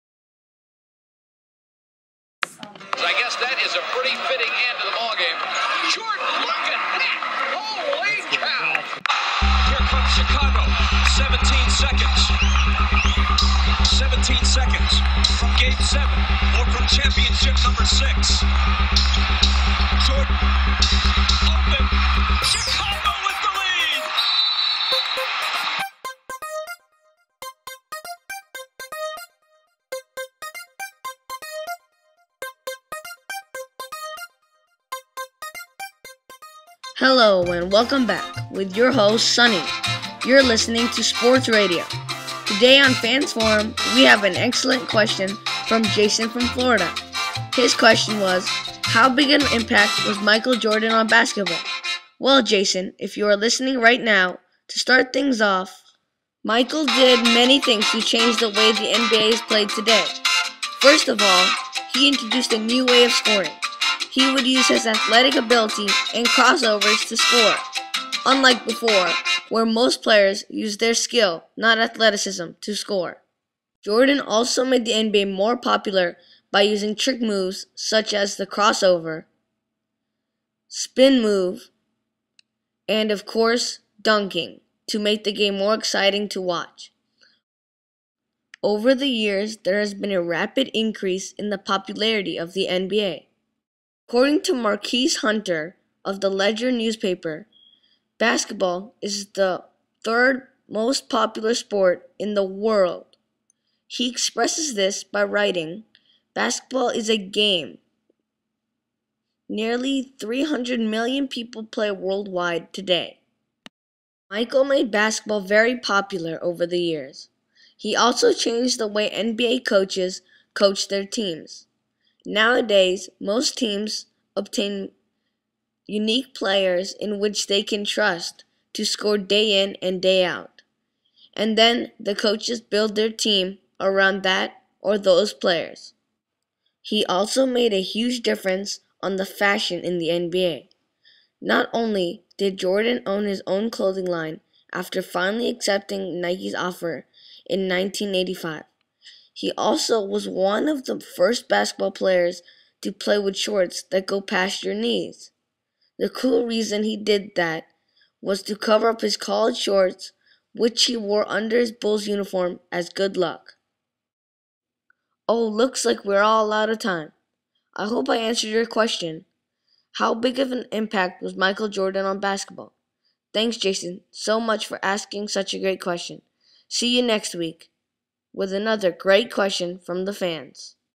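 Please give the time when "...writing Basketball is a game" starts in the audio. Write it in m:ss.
1:45.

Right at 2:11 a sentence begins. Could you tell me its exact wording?
And then the coaches build their team around that or those players.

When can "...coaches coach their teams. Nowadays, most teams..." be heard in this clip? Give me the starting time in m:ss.
1:59.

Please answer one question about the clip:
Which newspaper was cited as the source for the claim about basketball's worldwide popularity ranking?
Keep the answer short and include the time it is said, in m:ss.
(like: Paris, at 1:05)
The Ledger, at 1:36.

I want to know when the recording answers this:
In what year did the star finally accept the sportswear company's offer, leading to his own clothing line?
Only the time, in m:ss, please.
2:27.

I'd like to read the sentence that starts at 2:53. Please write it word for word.
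Thanks, Jason, so much for asking such a great question.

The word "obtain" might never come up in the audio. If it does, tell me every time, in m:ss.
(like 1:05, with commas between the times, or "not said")
2:04.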